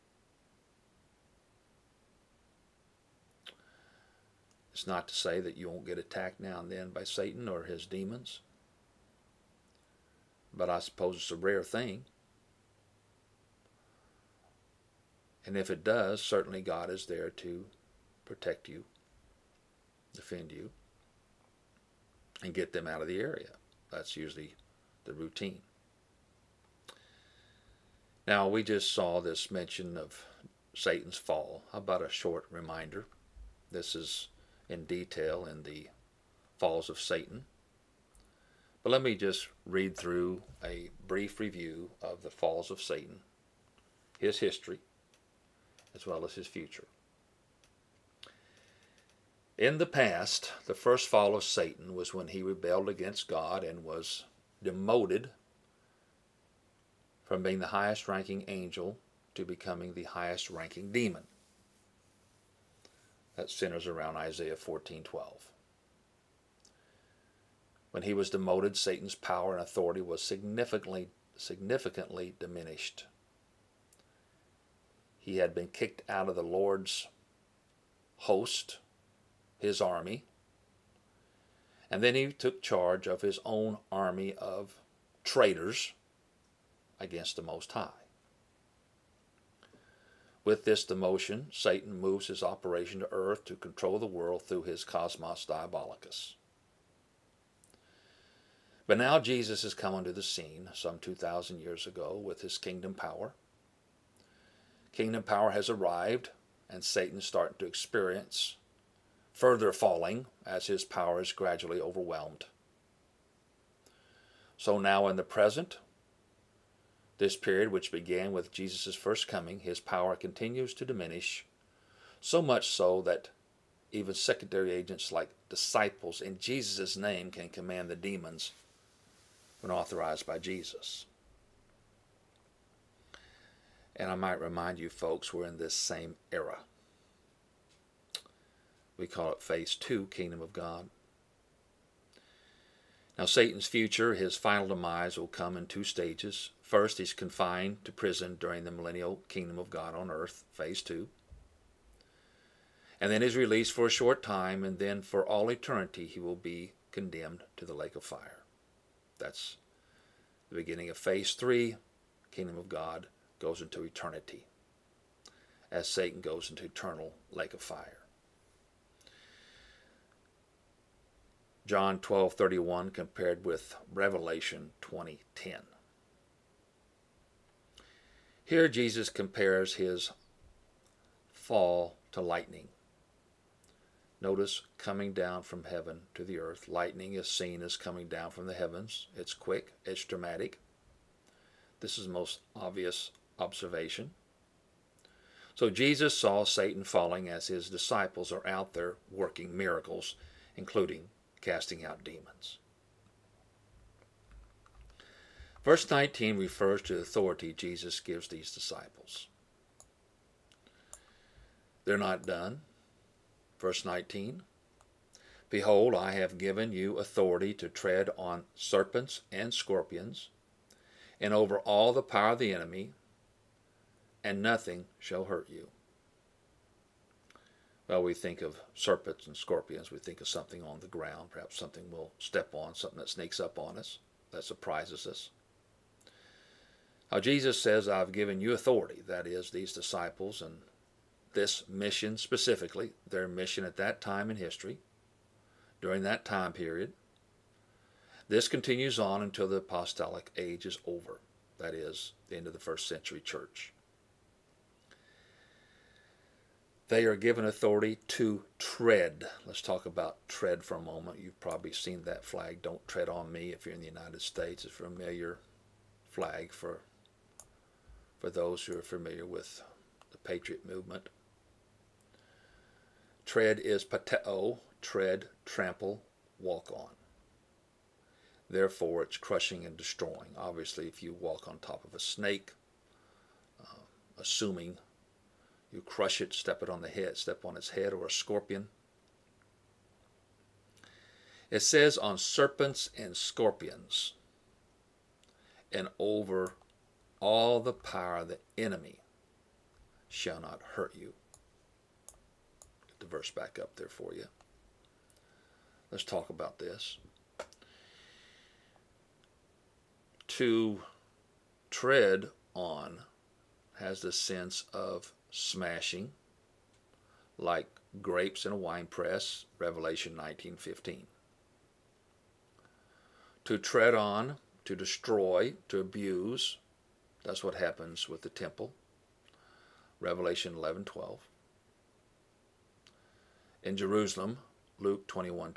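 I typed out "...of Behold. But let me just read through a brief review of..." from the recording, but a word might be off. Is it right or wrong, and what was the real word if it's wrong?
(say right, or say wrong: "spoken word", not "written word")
wrong: "Satan", not "Behold".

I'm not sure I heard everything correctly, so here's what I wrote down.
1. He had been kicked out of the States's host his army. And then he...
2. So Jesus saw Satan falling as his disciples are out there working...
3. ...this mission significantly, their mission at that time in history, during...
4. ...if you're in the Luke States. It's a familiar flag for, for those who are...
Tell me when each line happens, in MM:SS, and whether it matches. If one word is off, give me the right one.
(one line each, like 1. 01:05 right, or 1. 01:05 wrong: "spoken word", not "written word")
1. 01:15 wrong: "Lord", not "States"
2. 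03:15 right
3. 04:01 wrong: "specifically", not "significantly"
4. 04:23 wrong: "United", not "Luke".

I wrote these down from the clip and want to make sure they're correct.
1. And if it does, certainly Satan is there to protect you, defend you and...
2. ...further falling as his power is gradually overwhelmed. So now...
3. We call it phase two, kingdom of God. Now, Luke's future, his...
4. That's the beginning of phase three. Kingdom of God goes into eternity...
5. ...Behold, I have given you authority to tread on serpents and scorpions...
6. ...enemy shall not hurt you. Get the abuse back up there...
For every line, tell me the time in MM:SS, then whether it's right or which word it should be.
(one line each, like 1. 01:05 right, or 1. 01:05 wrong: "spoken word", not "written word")
1. 00:15 wrong: "God", not "Satan"
2. 01:49 right
3. 02:19 wrong: "Satan", not "Luke"
4. 02:39 right
5. 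03:35 right
6. 04:58 wrong: "verse", not "abuse".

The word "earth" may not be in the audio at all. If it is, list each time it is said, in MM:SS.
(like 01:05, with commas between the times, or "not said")
01:33, 02:30, 03:06.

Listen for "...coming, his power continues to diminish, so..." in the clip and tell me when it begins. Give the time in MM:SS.
01:59.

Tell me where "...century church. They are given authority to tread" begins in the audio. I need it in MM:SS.
04:12.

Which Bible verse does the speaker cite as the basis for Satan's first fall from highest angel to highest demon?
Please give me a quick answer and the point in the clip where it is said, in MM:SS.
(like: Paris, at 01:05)
Isaiah 14:12, at 01:04.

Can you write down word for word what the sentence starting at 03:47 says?
Well, we think of serpents and scorpions.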